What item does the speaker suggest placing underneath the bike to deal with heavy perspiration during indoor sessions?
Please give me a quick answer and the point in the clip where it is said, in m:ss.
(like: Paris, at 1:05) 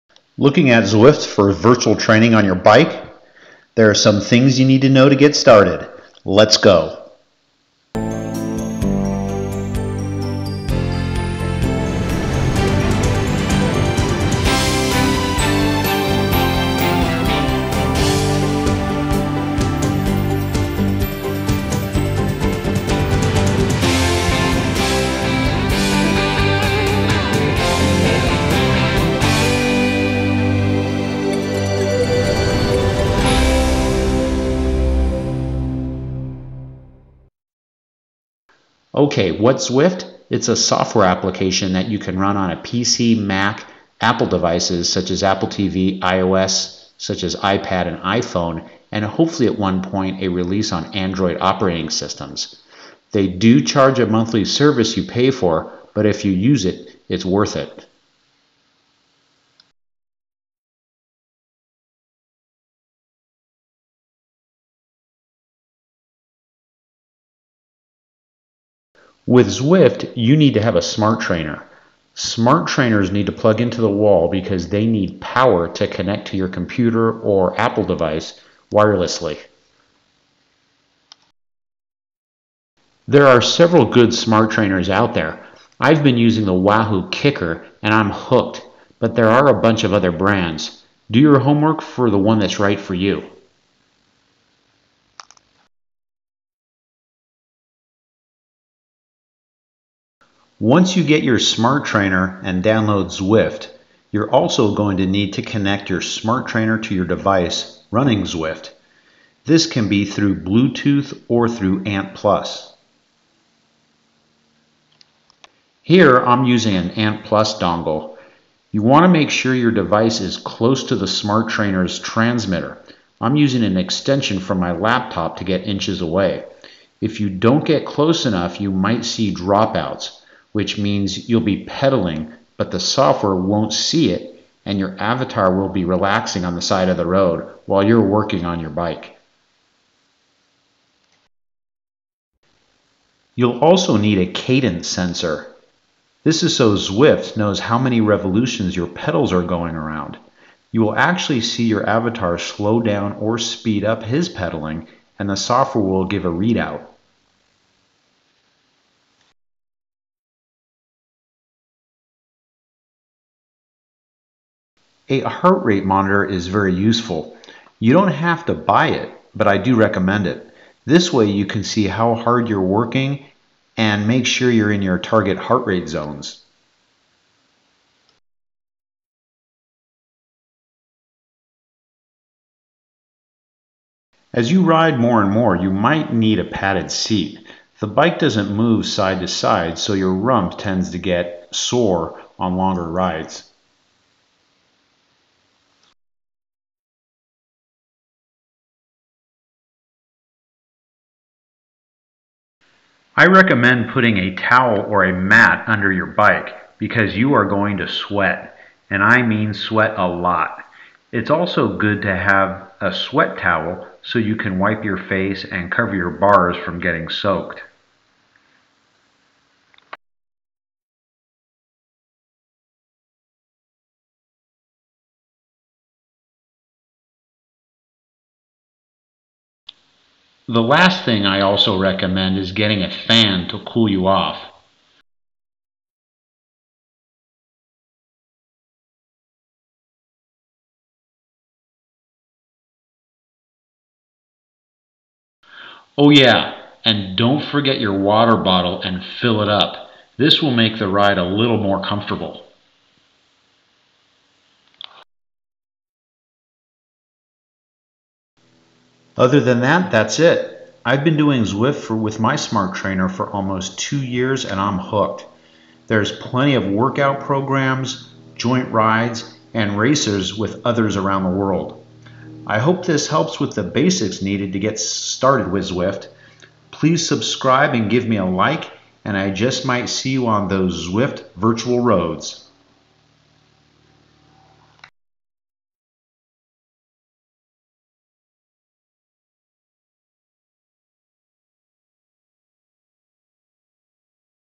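A towel or a mat, at 3:24.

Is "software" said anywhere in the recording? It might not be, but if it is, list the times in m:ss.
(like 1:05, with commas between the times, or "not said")
0:40, 2:12, 2:35.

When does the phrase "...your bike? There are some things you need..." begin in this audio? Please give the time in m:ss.
0:02.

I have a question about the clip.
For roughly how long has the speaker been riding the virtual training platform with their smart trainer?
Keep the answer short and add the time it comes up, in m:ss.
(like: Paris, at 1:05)
almost 2 years, at 4:23.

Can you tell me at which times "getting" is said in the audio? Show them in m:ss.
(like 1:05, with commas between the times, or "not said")
3:36, 3:52.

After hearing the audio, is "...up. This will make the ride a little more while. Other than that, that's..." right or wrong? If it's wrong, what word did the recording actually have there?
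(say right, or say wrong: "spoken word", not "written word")
wrong: "comfortable", not "while".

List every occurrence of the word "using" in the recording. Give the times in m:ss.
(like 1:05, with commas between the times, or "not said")
1:26, 1:56, 2:03.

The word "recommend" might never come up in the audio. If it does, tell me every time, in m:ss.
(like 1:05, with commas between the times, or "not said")
2:49, 3:23, 3:51.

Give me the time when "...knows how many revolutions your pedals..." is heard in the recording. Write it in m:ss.
2:27.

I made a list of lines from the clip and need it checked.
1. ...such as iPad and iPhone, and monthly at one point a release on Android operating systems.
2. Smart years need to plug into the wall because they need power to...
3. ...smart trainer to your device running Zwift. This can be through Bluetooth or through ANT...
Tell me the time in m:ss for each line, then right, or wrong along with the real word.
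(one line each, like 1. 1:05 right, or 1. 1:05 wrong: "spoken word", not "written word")
1. 0:46 wrong: "hopefully", not "monthly"
2. 1:12 wrong: "trainers", not "years"
3. 1:46 right.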